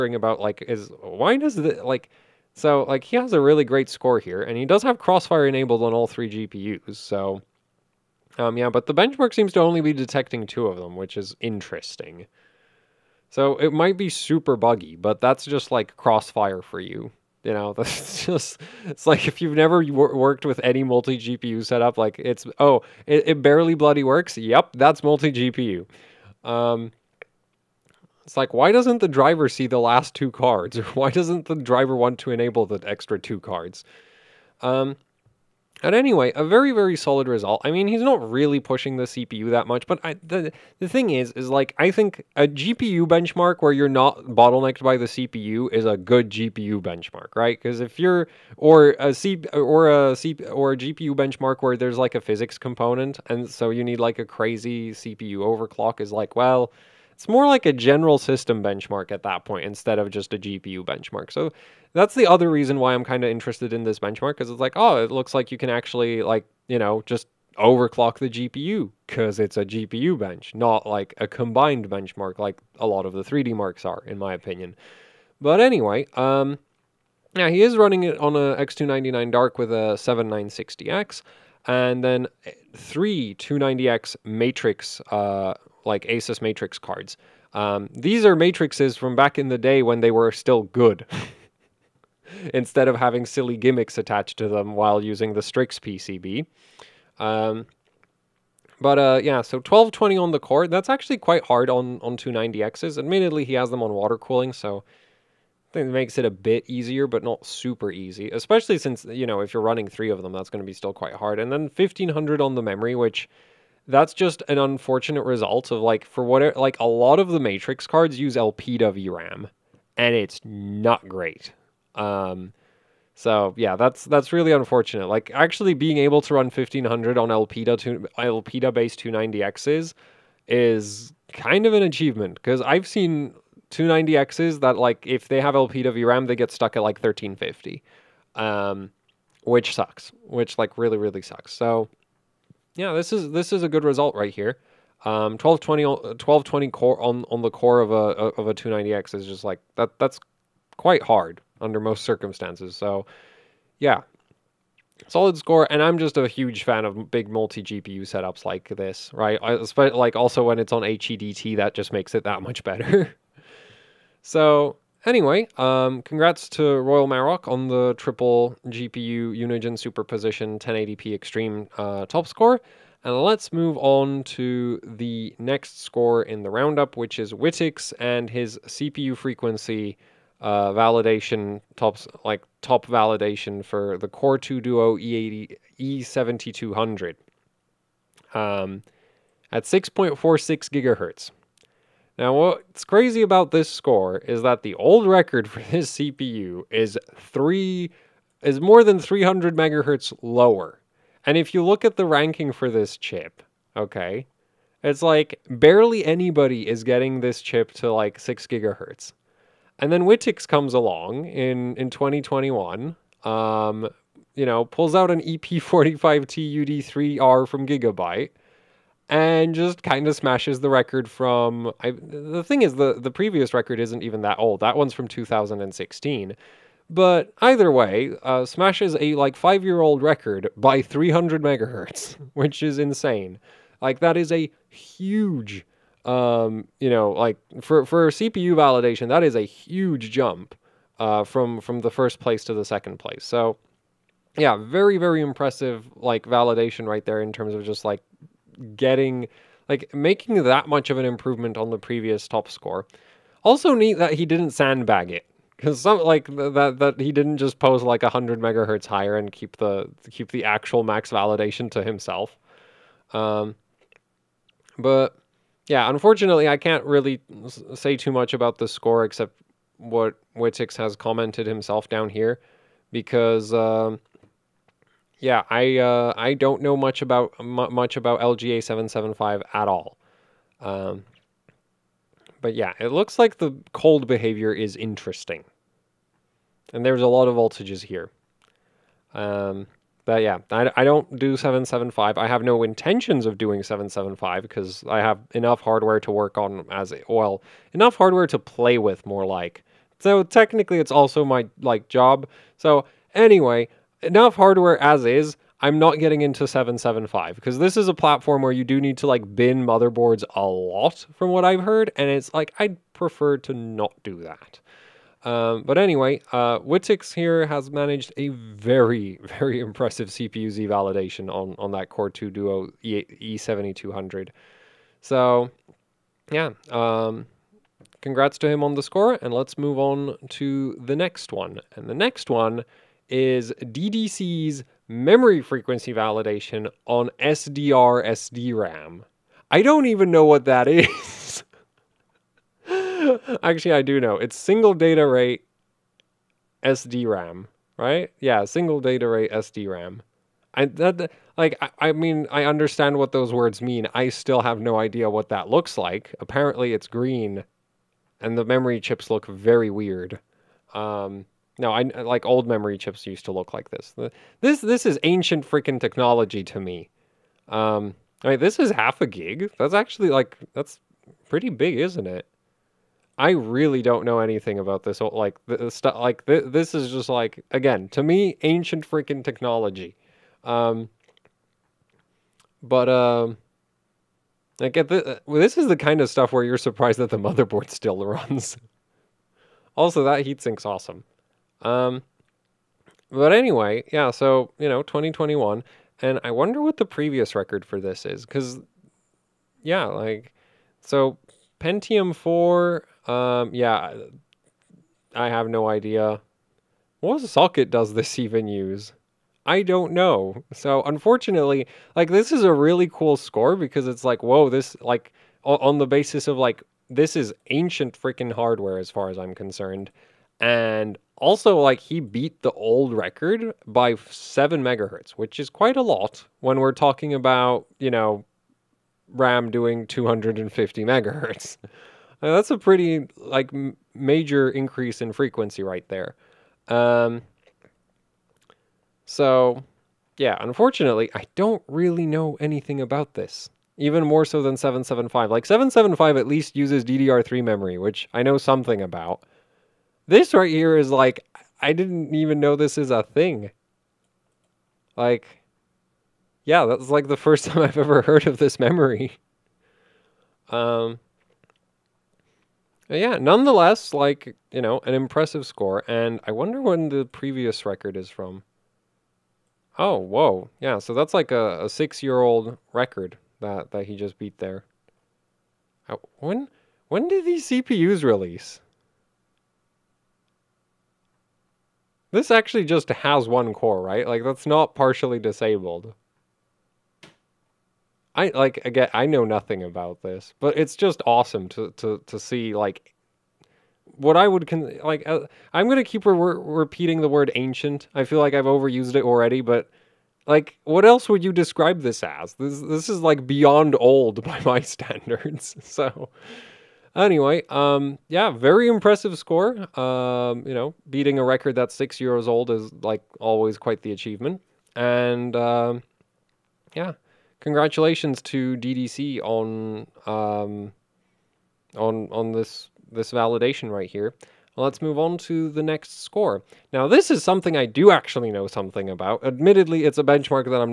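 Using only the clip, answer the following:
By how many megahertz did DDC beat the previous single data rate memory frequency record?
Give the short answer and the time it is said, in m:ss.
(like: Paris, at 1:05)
7, at 7:04.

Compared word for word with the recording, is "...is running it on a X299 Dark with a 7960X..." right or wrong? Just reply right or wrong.
right.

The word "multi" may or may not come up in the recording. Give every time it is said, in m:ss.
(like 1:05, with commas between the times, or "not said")
0:20, 0:25, 2:37.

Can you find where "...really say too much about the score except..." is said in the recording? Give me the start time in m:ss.
4:26.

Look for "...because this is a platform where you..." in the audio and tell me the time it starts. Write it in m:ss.
5:07.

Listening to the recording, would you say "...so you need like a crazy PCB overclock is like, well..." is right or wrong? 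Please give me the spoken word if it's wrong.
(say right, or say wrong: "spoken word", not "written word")
wrong: "CPU", not "PCB".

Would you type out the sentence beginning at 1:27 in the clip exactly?
Um, these are matrices from back in the day when they were still good.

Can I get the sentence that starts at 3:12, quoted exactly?
Now, what's crazy about this score is that the old record for this CPU is three is more than 300 megahertz lower.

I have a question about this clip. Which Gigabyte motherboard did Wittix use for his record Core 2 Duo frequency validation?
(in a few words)
EP45 TUD3R.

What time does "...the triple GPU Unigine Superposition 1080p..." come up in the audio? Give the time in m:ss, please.
2:47.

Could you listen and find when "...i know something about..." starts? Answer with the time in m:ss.
7:28.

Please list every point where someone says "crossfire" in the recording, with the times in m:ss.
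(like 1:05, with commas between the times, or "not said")
0:04, 0:15.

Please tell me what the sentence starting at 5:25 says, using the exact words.
So, yeah, um, congrats to him on the score, and let's move on to the next one.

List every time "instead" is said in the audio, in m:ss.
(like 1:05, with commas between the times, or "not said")
0:59, 1:32.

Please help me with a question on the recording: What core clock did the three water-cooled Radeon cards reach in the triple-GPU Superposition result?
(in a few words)
1220.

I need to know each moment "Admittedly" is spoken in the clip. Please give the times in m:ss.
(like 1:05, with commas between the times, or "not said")
1:42, 8:49.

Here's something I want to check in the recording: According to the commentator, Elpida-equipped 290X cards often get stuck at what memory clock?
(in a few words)
1350.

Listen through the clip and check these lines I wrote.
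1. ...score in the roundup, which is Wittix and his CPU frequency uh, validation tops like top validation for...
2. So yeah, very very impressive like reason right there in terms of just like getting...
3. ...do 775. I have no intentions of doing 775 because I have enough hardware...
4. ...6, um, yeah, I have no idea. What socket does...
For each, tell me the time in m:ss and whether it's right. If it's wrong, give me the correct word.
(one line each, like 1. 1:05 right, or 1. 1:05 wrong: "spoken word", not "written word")
1. 2:55 right
2. 4:03 wrong: "validation", not "reason"
3. 4:51 right
4. 6:42 wrong: "4", not "6".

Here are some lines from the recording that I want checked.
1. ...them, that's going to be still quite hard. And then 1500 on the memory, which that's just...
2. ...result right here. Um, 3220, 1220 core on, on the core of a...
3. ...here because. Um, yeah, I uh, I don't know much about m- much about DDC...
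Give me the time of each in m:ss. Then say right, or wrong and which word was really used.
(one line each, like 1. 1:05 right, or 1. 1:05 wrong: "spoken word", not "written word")
1. 1:50 right
2. 2:23 wrong: "1220", not "3220"
3. 4:32 wrong: "LGA", not "DDC".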